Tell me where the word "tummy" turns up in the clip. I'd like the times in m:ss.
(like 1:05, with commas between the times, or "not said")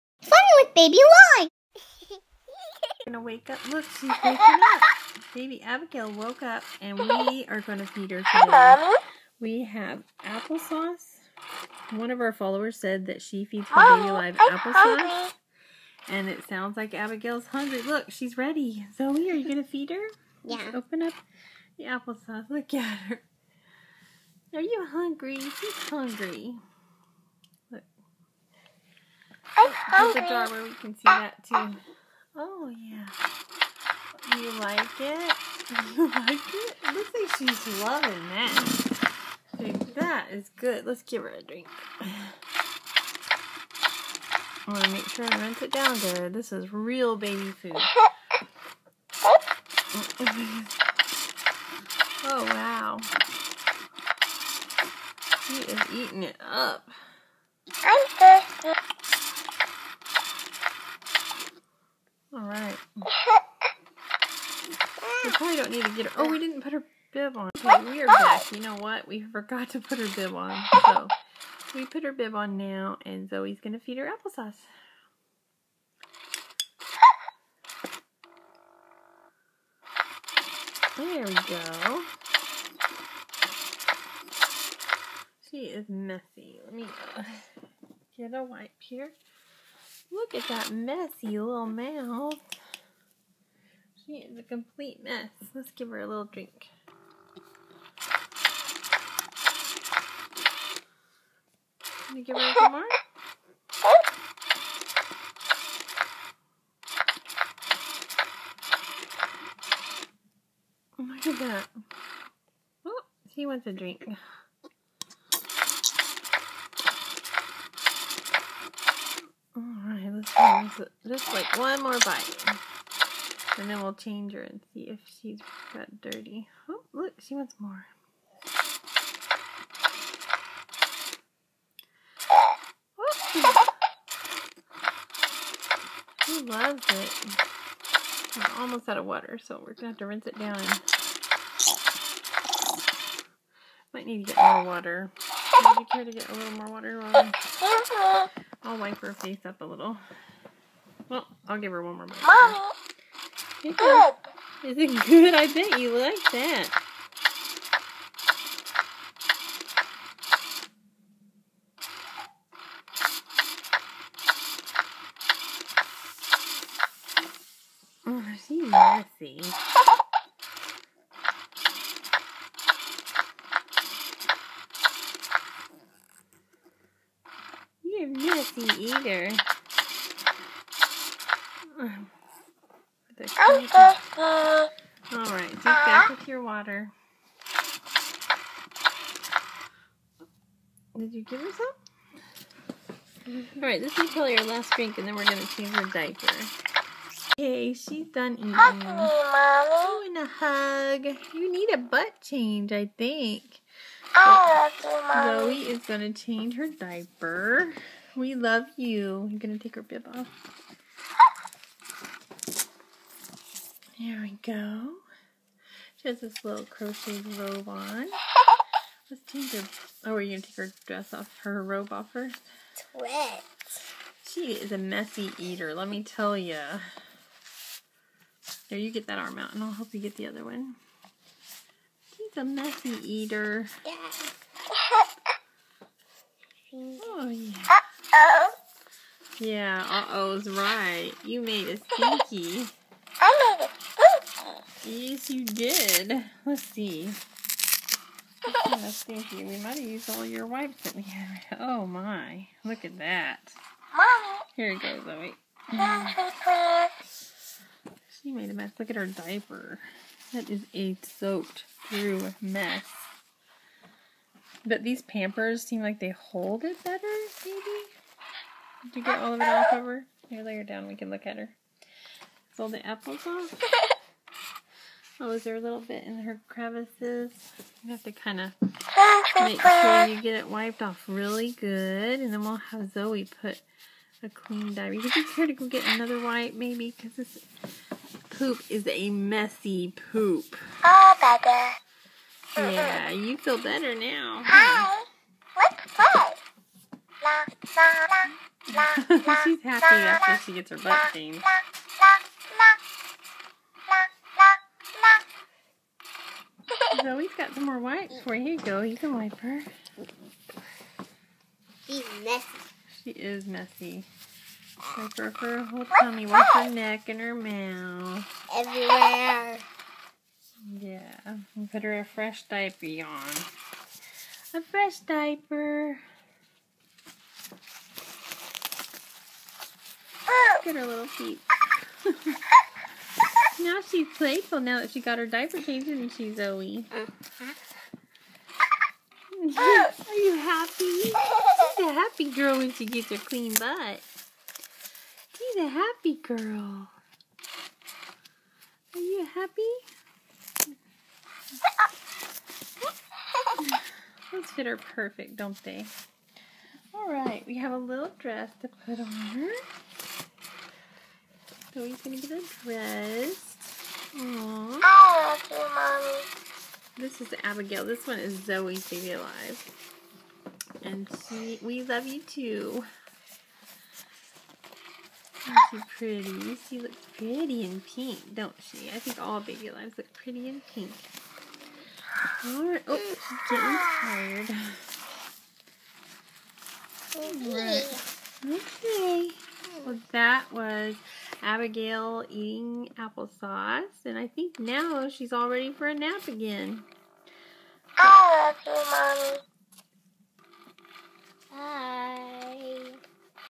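5:15.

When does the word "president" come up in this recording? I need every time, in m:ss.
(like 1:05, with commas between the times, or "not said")
not said.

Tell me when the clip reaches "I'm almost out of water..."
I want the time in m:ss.
2:18.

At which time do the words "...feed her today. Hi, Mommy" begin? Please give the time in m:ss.
0:07.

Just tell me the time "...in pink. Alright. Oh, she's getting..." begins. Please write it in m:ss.
6:20.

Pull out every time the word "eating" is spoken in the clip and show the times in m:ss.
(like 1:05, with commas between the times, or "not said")
0:55, 3:18, 6:32.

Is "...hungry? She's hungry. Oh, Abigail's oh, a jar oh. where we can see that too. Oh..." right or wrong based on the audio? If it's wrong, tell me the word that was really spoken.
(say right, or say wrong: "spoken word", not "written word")
wrong: "There", not "Abigail".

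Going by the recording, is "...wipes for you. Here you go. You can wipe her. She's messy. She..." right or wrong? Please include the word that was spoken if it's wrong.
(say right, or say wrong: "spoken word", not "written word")
right.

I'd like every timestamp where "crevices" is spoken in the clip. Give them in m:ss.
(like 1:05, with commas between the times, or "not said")
4:36.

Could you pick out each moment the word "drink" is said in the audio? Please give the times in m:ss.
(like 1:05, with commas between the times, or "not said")
0:41, 1:36, 1:53, 3:14.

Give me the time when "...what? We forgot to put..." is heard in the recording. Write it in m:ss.
1:08.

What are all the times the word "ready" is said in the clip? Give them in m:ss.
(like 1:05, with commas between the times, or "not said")
0:18, 6:35.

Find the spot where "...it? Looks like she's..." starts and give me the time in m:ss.
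0:36.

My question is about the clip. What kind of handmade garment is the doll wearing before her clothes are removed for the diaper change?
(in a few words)
crochet robe.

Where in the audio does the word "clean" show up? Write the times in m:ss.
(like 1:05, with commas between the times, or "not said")
4:44, 5:43.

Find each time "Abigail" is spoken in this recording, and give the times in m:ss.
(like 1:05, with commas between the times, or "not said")
0:05, 0:16, 6:07, 6:31.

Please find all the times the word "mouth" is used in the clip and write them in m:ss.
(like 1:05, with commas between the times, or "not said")
1:31, 5:17.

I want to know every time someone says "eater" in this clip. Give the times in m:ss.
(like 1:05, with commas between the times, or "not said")
2:58, 3:45, 3:53.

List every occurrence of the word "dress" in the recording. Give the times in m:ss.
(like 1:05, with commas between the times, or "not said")
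3:40, 5:58, 6:02.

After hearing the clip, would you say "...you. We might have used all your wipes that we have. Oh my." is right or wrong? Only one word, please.
right.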